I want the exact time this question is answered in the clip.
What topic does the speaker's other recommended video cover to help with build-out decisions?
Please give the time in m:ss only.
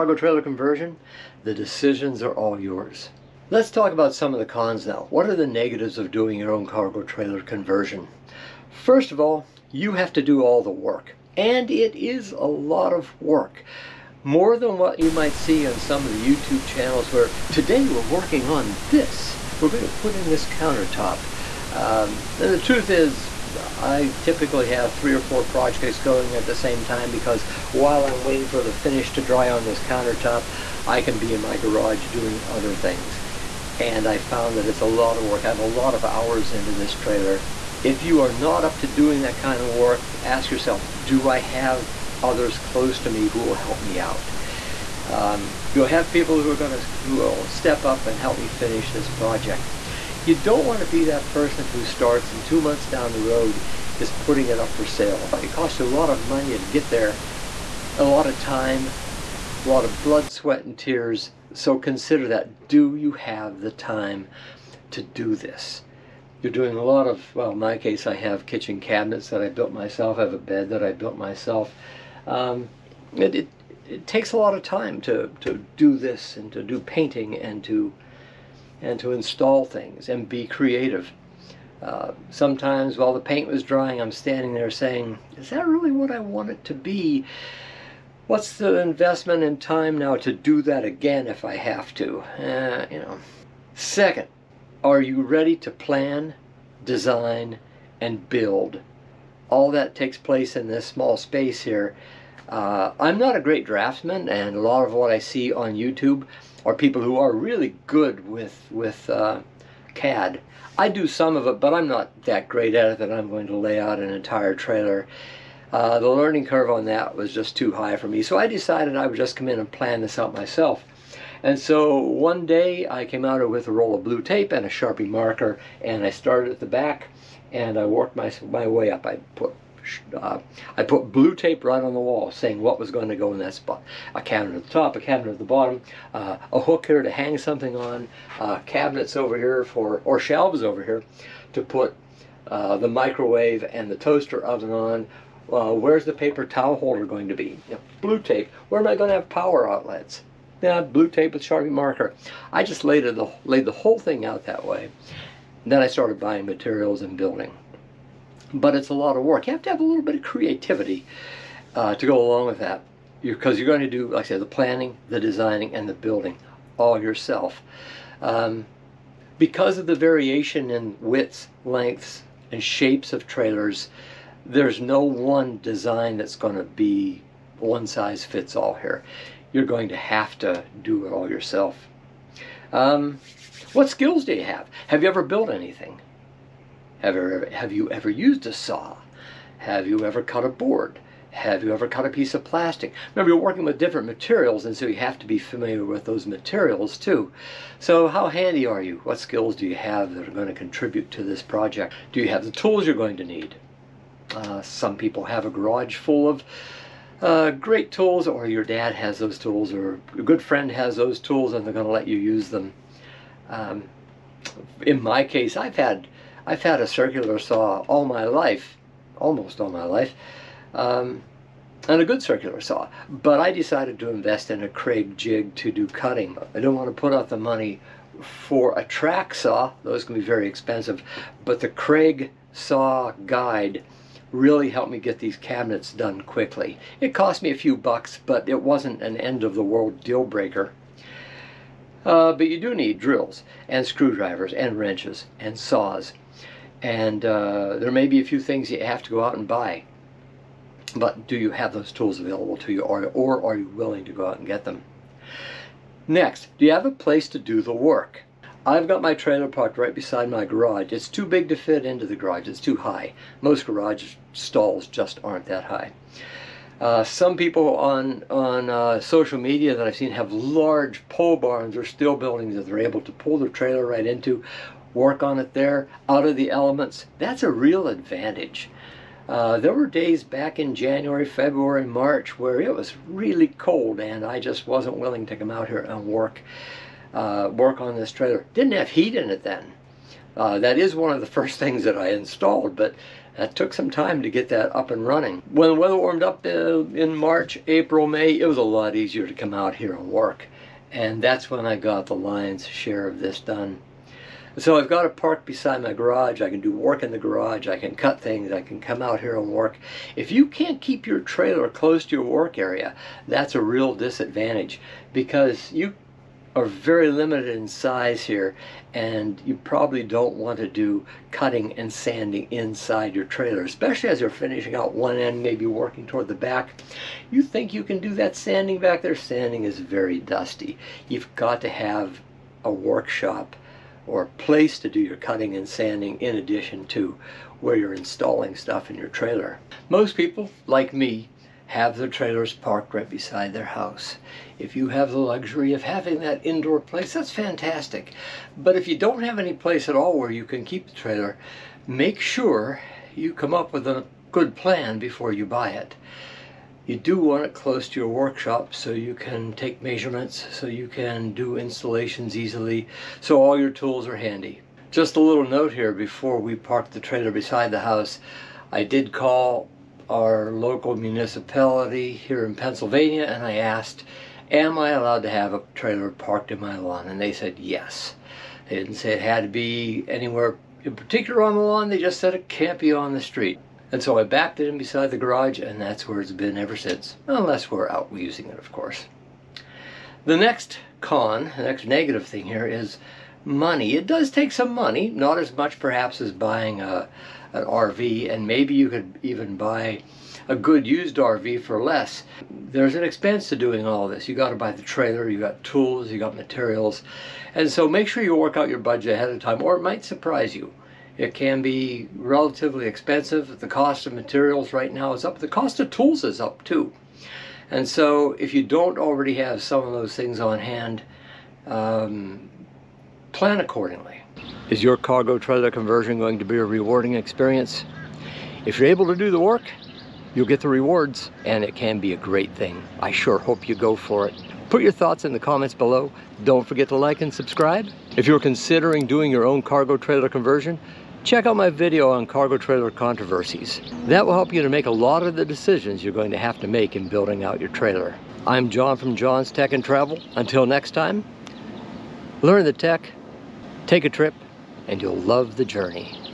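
7:22.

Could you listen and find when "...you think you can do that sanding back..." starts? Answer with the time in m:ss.
5:27.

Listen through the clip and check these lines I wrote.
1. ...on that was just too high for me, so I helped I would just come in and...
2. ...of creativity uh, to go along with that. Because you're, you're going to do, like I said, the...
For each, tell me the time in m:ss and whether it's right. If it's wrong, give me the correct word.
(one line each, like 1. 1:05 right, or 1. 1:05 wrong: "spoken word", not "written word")
1. 1:56 wrong: "decided", not "helped"
2. 2:40 right.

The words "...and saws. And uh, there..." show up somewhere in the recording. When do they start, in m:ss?
4:05.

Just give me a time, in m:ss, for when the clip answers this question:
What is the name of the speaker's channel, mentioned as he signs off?
7:29.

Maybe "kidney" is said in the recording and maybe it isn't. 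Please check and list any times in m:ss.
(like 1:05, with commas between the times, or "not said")
not said.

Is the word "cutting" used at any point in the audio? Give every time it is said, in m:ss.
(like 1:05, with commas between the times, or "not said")
3:45, 5:21, 5:35.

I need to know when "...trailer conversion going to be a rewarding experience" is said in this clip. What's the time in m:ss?
7:05.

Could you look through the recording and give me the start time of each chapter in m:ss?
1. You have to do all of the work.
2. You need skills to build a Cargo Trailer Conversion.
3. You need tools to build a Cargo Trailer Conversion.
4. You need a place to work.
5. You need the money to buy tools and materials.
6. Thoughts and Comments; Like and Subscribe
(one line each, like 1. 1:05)
1. 0:09
2. 3:02
3. 3:21
4. 4:14
5. 6:31
6. 7:03.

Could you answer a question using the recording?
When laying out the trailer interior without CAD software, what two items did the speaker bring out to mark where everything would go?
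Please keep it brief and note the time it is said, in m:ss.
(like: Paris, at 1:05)
Blue tape and a Sharpie marker, at 2:03.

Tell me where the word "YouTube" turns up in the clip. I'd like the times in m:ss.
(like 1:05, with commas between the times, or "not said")
0:16, 1:45.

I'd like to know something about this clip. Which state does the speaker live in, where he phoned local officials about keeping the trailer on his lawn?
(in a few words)
Pennsylvania.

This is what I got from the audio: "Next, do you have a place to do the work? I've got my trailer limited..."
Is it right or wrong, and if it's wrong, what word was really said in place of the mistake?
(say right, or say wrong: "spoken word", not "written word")
wrong: "parked", not "limited".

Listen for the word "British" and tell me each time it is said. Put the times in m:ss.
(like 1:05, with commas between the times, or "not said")
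not said.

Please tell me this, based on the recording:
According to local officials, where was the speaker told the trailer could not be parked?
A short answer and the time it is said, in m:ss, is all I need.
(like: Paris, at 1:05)
On the street, at 6:22.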